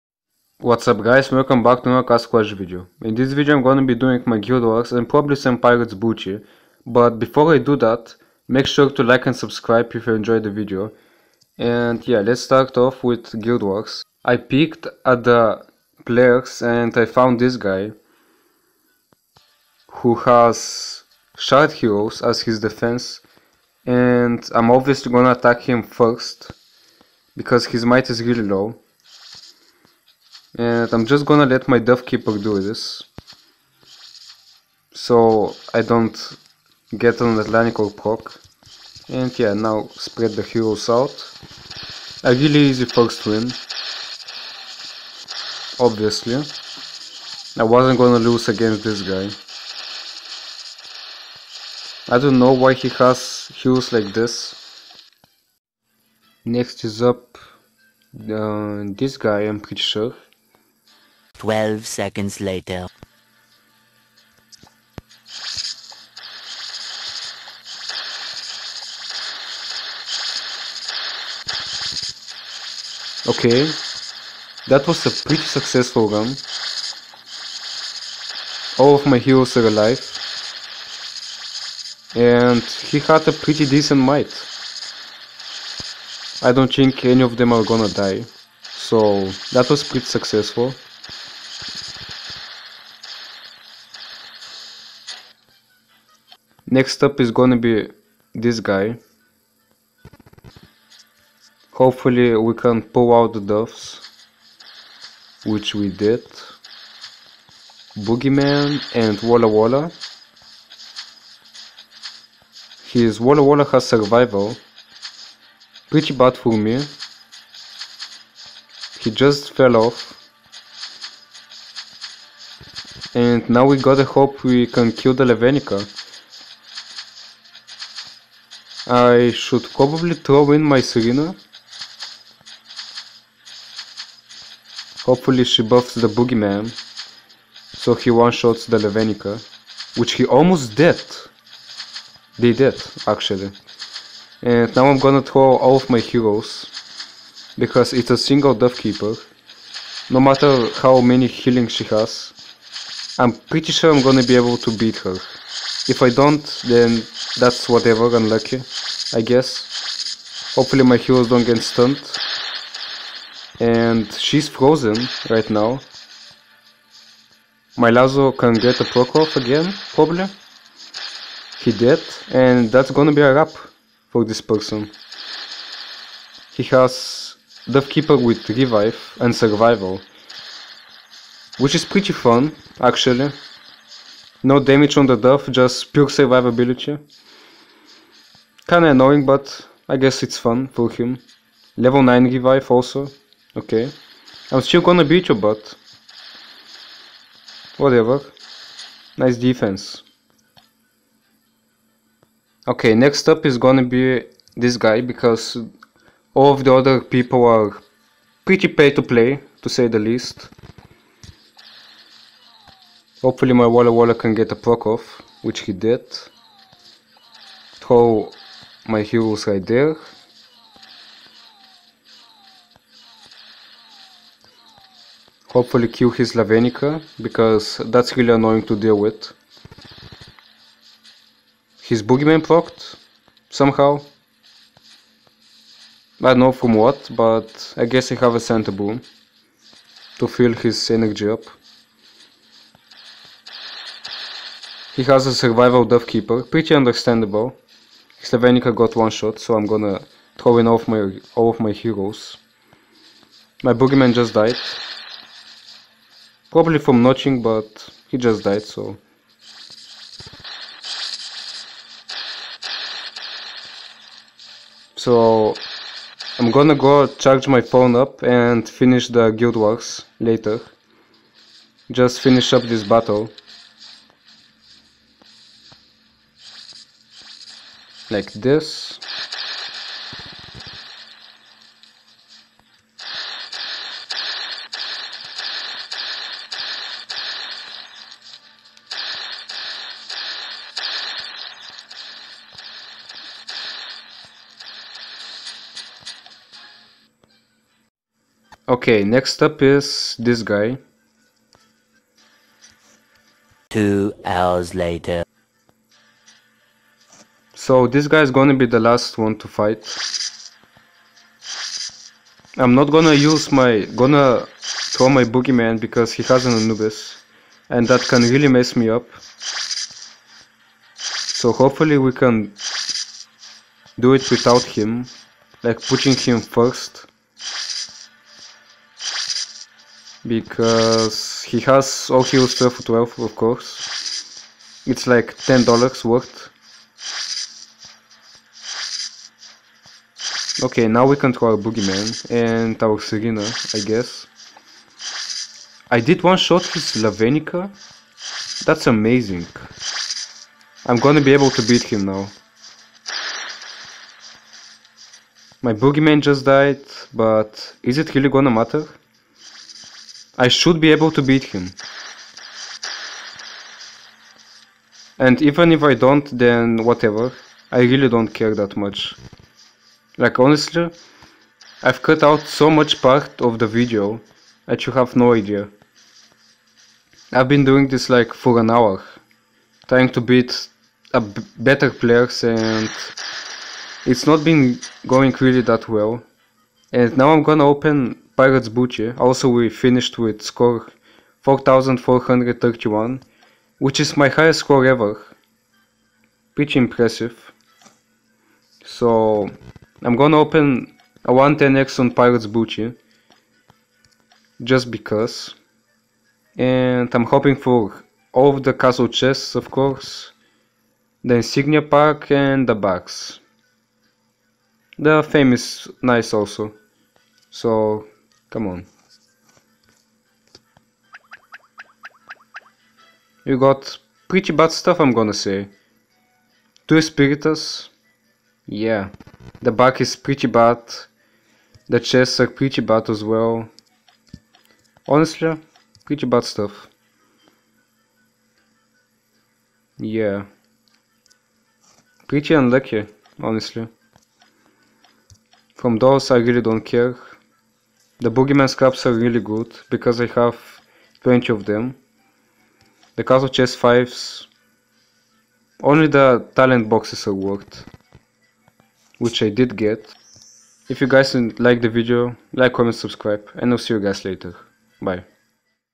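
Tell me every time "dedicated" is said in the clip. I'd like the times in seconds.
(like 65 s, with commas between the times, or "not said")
not said.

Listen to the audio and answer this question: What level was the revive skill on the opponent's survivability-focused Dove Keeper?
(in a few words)
Level 9.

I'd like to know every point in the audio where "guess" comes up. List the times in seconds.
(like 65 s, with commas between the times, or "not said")
159 s, 189 s, 237 s, 343 s.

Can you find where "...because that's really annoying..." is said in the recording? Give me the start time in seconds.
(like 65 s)
227 s.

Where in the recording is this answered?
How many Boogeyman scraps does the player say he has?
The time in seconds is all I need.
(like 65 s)
451 s.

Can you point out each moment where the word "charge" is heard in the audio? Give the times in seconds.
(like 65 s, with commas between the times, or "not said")
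267 s.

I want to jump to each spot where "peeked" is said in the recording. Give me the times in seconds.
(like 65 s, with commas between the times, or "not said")
14 s.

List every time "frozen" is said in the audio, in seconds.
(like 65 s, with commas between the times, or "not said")
164 s.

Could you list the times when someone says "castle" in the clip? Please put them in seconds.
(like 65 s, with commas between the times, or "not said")
2 s, 408 s, 453 s.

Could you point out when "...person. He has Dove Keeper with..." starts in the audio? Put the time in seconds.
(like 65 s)
174 s.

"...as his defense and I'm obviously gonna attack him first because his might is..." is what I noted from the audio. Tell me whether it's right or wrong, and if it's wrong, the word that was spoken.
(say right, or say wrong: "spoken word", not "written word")
right.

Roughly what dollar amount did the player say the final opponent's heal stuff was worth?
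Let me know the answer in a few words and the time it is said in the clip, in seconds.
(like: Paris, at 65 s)
$10, at 335 s.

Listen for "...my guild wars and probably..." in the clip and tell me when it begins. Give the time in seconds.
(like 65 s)
4 s.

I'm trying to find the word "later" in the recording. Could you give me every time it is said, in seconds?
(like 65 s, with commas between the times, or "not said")
62 s, 270 s, 304 s, 464 s.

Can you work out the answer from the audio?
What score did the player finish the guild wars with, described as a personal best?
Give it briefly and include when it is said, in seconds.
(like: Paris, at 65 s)
4431, at 390 s.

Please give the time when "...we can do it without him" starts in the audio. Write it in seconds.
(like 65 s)
321 s.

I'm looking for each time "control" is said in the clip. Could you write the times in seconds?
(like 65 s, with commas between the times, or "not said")
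341 s.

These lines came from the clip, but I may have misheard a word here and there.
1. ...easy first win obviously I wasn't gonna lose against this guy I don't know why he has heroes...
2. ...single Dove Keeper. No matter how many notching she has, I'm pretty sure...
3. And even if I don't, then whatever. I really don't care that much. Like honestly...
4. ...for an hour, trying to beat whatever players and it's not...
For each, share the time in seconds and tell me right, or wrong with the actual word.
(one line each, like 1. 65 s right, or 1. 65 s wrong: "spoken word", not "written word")
1. 42 s right
2. 148 s wrong: "healing", not "notching"
3. 365 s right
4. 378 s wrong: "better", not "whatever".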